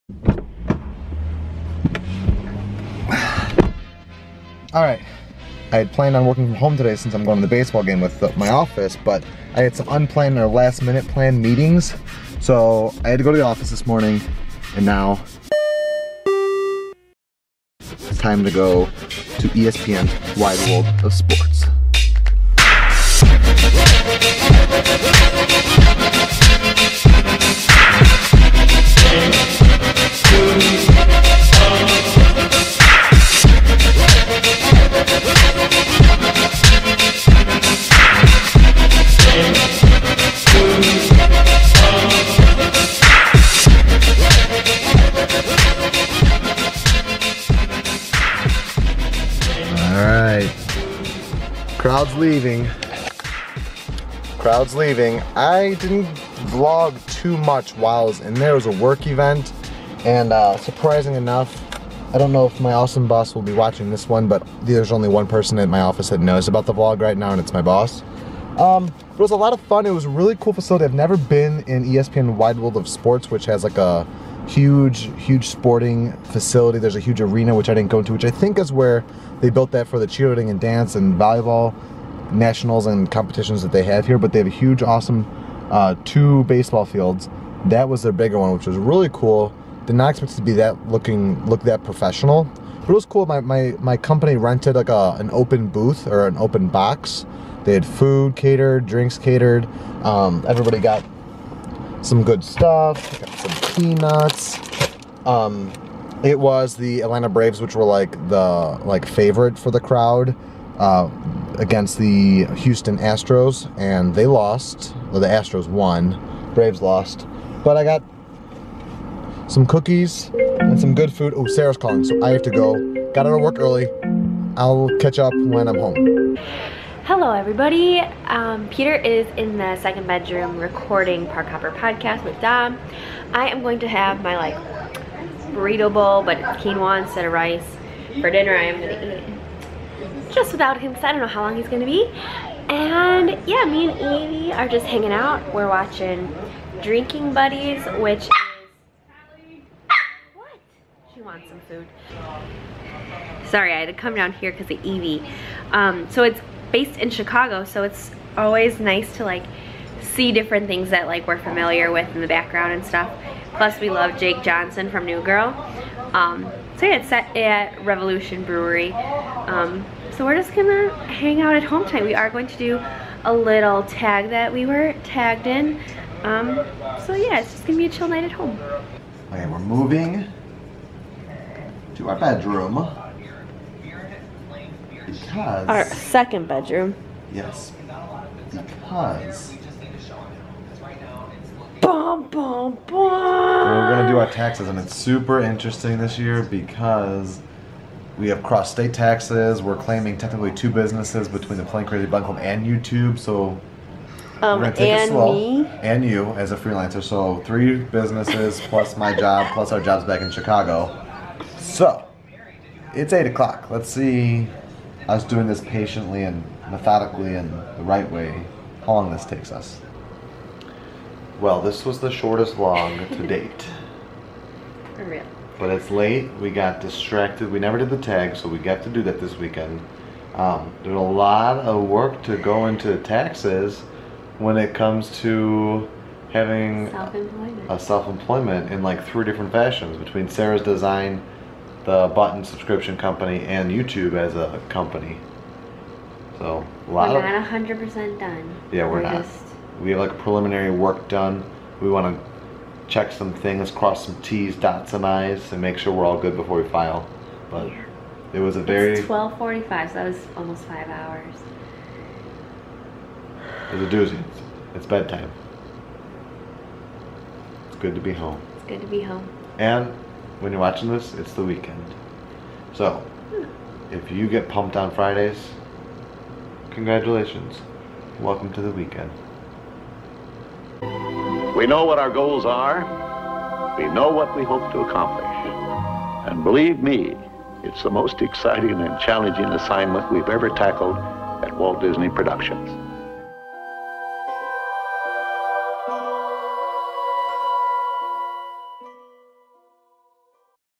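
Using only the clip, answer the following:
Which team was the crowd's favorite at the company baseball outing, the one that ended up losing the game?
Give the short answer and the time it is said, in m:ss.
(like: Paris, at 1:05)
Atlanta Braves, at 1:47.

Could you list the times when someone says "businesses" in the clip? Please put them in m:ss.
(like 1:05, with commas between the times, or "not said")
3:20, 3:27.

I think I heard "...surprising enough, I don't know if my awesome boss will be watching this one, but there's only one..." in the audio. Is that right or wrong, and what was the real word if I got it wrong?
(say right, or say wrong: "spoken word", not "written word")
right.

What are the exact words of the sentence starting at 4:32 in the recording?
So, if you get pumped on Fridays, congratulations.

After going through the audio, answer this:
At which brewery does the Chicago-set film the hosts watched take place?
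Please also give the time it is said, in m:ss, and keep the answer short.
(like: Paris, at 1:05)
Revolution Brewery, at 2:47.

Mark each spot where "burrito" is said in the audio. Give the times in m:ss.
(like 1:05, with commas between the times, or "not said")
2:15.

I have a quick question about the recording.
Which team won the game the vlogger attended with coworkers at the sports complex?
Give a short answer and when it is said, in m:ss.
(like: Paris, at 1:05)
Houston Astros, at 1:52.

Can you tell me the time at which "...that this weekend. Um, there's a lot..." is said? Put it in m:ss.
3:49.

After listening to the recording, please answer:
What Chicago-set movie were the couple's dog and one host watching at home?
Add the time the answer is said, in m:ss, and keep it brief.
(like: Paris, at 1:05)
Drinking Buddies, at 2:26.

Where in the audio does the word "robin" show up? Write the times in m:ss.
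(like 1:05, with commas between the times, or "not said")
not said.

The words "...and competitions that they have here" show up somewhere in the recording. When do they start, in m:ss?
1:22.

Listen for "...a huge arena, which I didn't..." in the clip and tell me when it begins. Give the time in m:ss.
1:16.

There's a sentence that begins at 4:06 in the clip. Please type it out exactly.
So a lot we're not 100% done.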